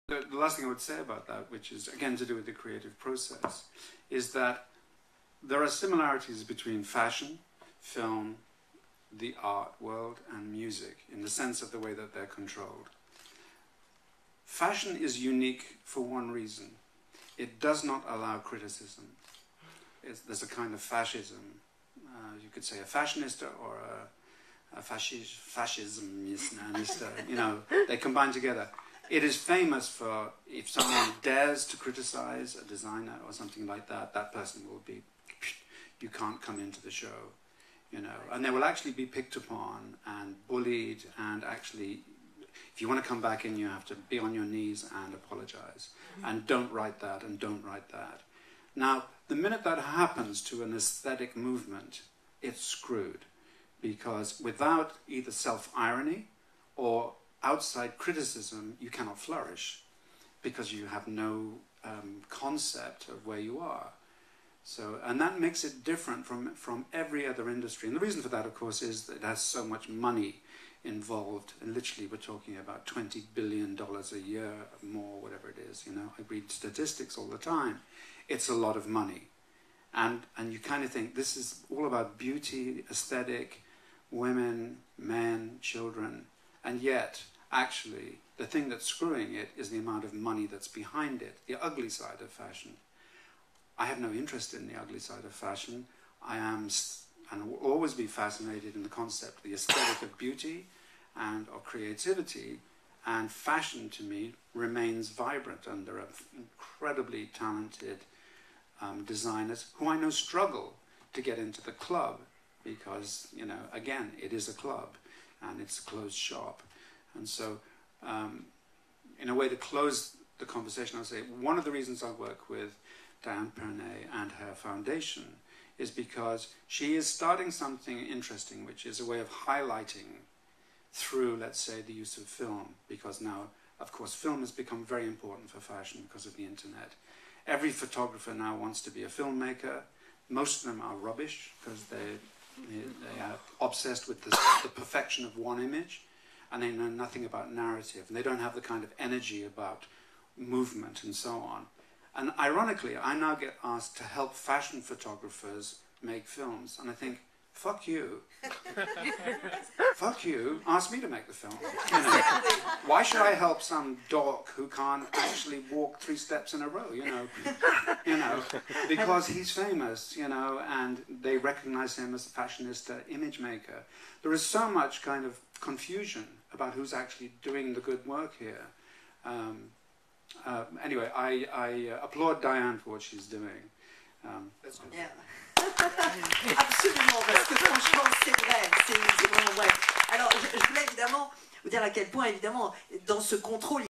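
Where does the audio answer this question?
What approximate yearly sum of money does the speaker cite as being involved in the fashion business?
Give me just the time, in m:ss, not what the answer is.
1:12.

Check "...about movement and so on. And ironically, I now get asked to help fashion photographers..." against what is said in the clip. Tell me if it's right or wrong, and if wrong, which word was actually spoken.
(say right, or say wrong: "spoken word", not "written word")
right.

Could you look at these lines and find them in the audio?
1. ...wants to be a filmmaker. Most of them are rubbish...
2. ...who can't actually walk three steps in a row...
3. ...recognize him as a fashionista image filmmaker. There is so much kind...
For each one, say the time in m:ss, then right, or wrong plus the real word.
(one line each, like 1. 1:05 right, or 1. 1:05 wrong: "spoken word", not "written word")
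1. 2:18 right
2. 2:44 right
3. 2:51 wrong: "maker", not "filmmaker".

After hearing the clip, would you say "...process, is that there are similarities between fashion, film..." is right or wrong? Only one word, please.
right.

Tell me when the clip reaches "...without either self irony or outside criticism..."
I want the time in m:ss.
0:54.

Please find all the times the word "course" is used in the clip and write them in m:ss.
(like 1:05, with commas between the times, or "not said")
1:08, 2:13.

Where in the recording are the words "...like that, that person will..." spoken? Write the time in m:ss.
0:33.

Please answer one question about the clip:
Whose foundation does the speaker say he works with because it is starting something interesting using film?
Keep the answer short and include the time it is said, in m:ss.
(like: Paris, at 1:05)
Diane Pernet, at 2:03.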